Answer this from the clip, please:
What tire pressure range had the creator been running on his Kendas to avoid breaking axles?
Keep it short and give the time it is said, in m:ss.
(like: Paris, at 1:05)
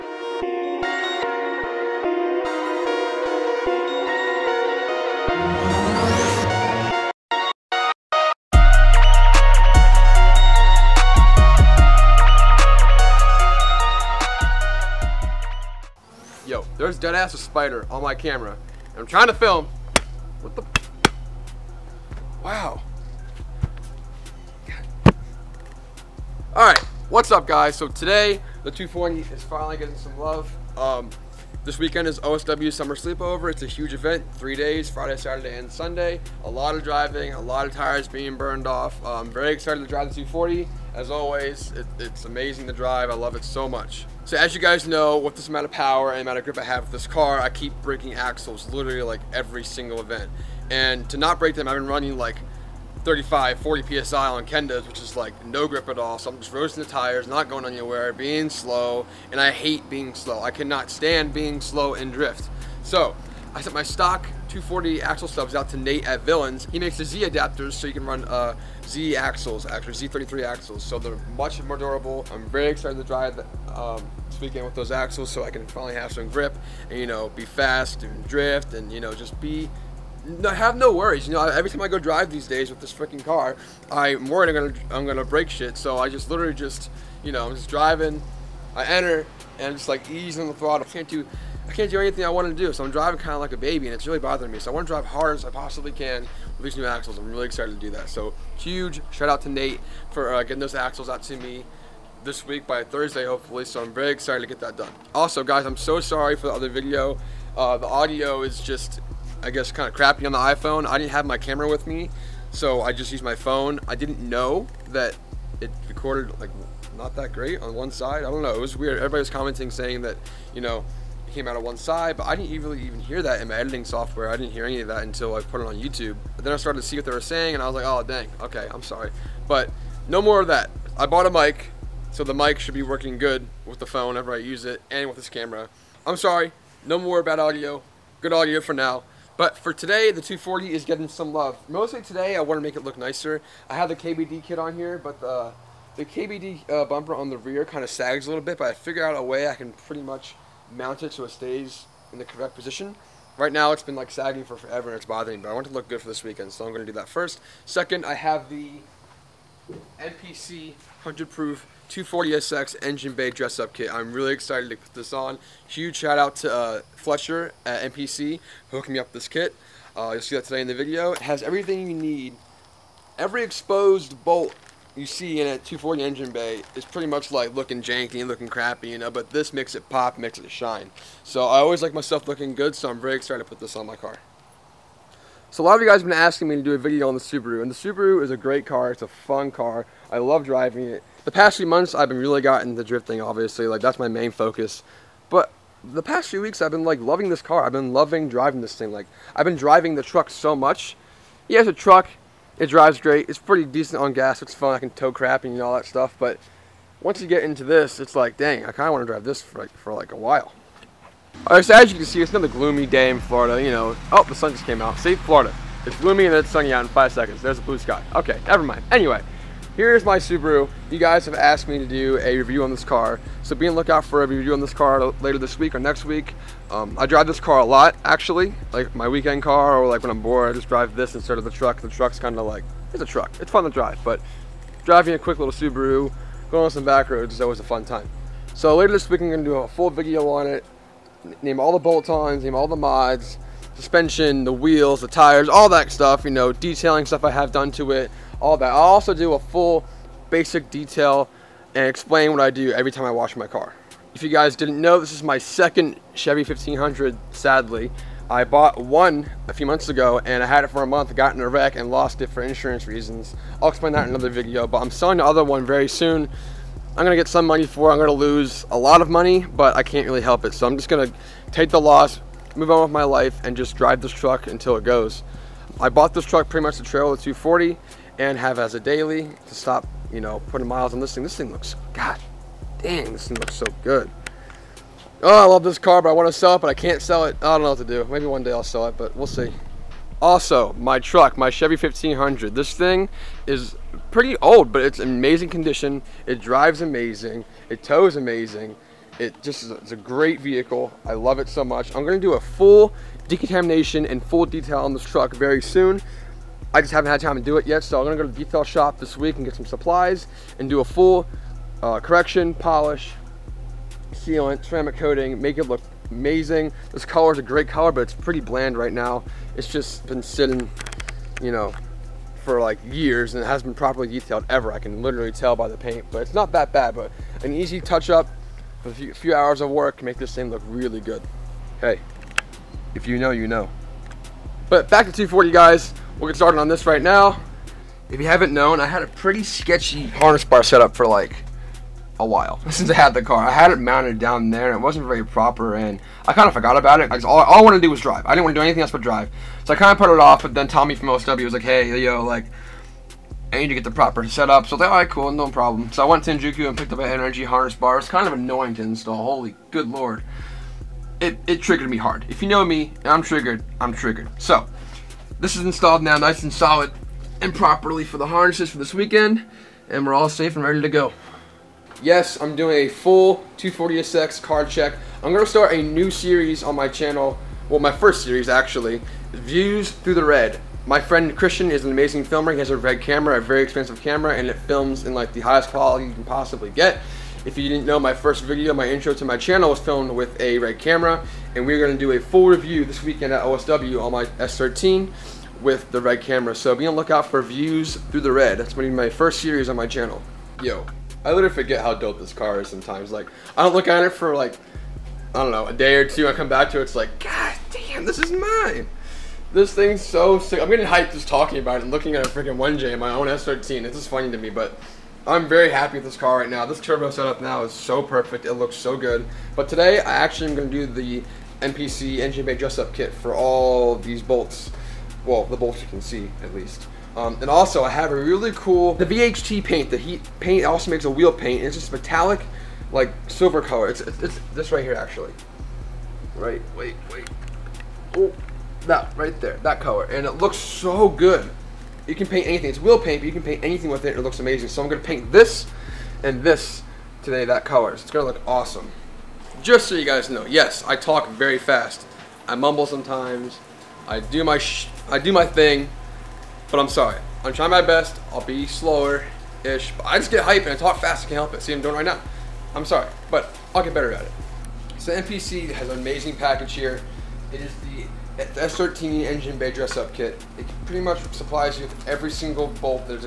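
35-40 PSI, at 0:53.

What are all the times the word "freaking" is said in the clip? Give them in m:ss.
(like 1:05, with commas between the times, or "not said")
1:22, 6:52.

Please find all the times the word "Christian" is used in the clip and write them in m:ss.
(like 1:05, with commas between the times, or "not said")
6:21.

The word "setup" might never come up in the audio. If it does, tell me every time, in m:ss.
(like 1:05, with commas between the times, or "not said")
5:54, 6:57.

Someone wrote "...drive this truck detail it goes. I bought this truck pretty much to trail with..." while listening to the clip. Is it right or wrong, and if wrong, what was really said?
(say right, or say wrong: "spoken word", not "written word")
wrong: "until", not "detail".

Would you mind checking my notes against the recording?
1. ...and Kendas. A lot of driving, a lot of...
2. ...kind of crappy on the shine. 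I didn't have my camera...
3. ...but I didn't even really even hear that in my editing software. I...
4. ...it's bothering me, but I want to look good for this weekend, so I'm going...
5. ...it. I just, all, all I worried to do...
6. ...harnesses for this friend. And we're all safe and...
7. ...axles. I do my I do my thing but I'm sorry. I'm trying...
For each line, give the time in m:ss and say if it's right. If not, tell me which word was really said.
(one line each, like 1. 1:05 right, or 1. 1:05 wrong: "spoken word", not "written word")
1. 0:35 wrong: "Sunday", not "Kendas"
2. 1:49 wrong: "iPhone", not "shine"
3. 2:02 right
4. 2:34 right
5. 5:46 wrong: "wanted", not "worried"
6. 6:08 wrong: "weekend", not "friend"
7. 7:32 wrong: "sometimes", not "axles".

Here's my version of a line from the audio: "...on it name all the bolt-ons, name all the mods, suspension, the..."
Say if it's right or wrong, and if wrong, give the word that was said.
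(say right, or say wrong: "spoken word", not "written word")
right.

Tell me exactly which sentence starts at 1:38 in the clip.
So huge shout out to Nate for uh, getting those axles out to me this week by Thursday, hopefully.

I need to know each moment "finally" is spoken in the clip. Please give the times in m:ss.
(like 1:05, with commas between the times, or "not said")
0:29, 1:15.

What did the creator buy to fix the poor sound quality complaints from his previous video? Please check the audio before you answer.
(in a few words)
a mic.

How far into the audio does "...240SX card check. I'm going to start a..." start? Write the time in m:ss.
6:13.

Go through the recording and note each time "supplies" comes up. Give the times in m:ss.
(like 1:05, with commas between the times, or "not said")
5:09, 7:51.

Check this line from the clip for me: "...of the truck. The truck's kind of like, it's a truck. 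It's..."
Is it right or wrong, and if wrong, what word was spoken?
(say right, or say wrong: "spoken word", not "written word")
right.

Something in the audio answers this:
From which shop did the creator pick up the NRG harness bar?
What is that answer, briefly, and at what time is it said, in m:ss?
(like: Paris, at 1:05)
Enjuku, at 5:56.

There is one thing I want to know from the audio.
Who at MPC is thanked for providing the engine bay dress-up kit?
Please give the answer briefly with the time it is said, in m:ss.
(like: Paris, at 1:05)
Fletcher, at 2:46.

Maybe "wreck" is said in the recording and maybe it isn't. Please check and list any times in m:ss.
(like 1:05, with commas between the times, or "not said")
4:21.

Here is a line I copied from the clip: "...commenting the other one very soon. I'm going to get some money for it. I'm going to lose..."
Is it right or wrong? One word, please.
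wrong.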